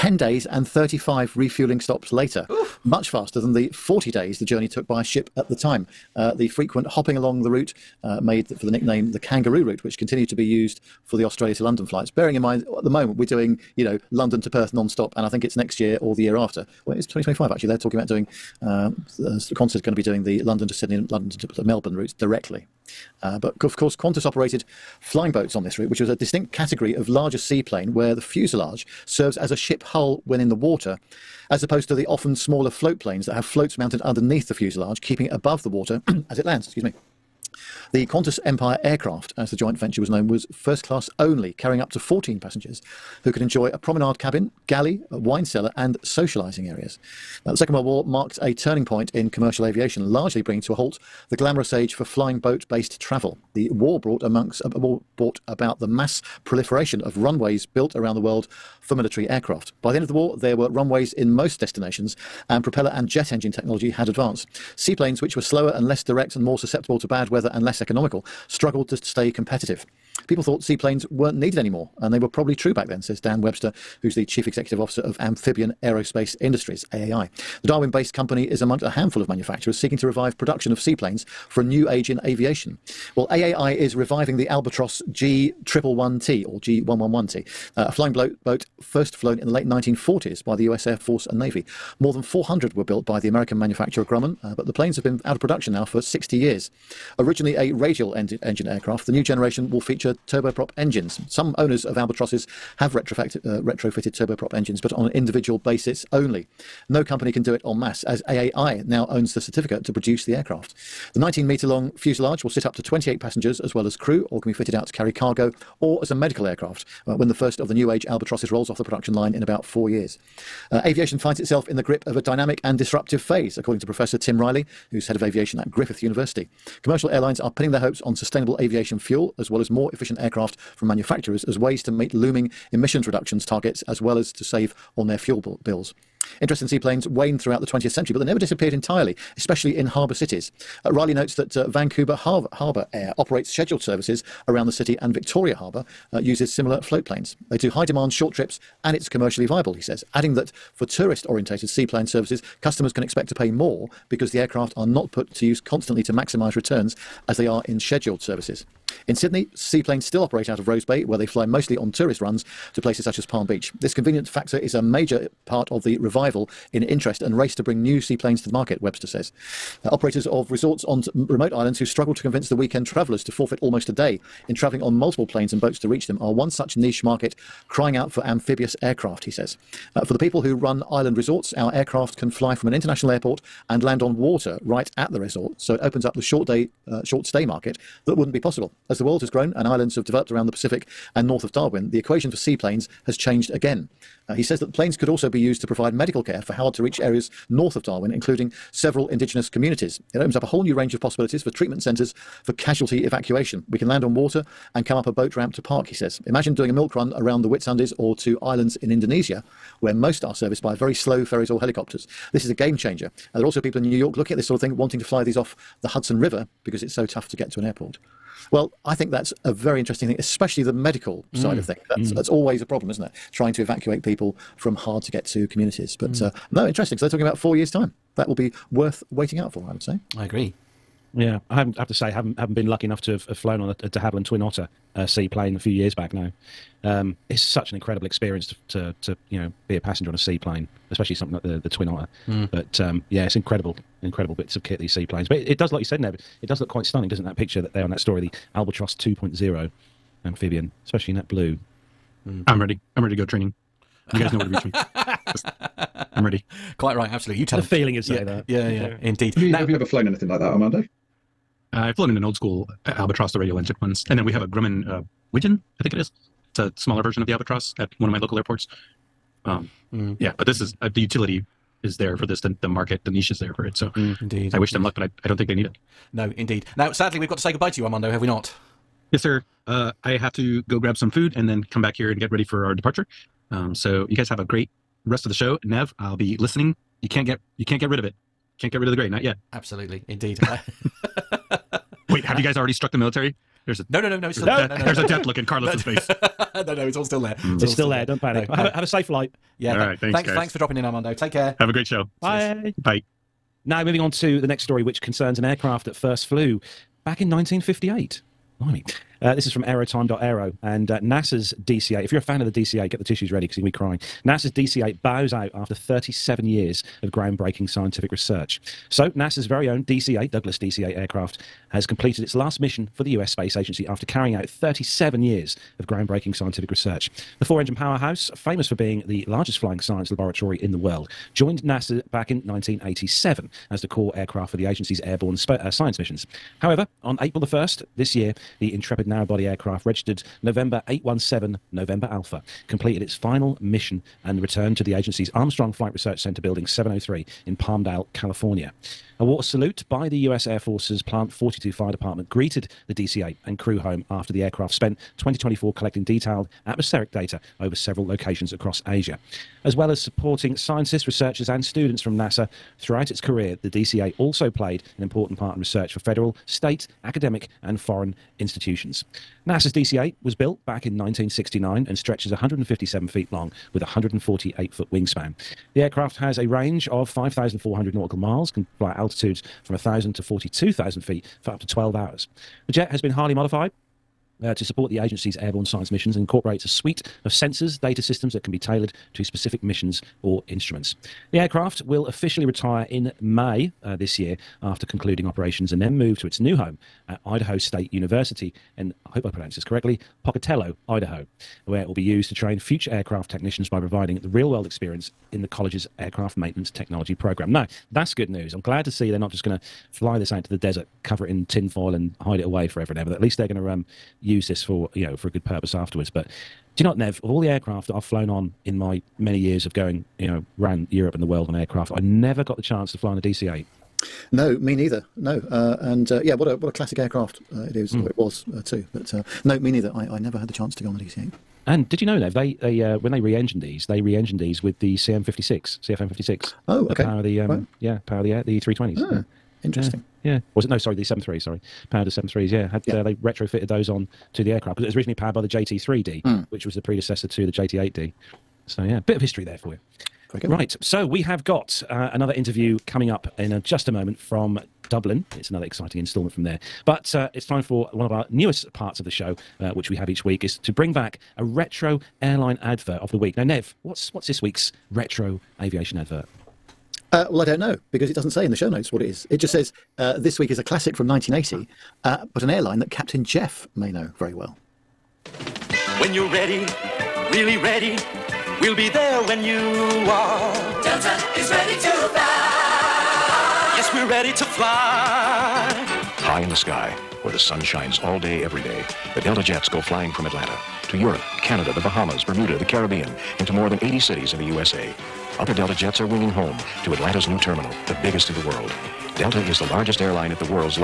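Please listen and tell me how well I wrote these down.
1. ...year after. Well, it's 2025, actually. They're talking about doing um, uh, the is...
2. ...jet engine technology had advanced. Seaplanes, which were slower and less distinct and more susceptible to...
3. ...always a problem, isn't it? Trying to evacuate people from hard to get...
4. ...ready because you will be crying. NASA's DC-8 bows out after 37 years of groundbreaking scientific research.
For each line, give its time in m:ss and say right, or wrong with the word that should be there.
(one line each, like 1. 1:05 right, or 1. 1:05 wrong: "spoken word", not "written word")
1. 0:16 right
2. 1:03 wrong: "direct", not "distinct"
3. 3:42 right
4. 5:13 right.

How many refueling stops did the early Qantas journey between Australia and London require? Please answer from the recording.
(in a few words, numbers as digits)
35.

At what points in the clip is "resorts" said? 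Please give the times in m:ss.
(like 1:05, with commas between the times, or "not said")
2:50, 3:01, 3:05.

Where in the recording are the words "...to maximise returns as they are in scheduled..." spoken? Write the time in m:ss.
2:36.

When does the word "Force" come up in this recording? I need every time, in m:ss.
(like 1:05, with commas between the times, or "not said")
1:30, 5:50.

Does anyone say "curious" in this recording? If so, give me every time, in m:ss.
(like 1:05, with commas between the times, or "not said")
not said.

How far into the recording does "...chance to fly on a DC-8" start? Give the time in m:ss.
7:02.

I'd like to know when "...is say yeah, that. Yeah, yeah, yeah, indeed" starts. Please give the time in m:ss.
4:17.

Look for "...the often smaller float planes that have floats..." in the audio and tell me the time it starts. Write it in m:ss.
0:31.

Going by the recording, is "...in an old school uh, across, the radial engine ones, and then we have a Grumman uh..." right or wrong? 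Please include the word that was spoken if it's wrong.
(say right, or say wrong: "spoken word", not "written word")
wrong: "albatross", not "across".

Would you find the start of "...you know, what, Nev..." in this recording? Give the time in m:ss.
6:56.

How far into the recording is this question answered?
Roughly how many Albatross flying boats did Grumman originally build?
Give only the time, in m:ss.
1:31.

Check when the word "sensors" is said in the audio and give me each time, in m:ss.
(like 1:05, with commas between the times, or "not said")
6:27.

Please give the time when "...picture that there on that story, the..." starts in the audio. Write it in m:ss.
4:07.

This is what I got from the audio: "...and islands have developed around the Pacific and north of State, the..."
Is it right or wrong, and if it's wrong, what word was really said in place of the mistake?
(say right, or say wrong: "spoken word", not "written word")
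wrong: "Darwin", not "State".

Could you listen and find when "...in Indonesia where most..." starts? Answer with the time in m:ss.
3:28.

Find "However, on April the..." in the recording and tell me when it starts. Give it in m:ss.
5:36.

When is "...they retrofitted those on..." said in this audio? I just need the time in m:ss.
7:23.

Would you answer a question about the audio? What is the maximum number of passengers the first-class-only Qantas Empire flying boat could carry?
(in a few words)
14.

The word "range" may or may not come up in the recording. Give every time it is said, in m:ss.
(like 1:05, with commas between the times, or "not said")
3:20, 6:16.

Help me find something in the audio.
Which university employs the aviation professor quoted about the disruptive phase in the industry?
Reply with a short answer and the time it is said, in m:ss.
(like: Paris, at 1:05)
Griffith University, at 2:05.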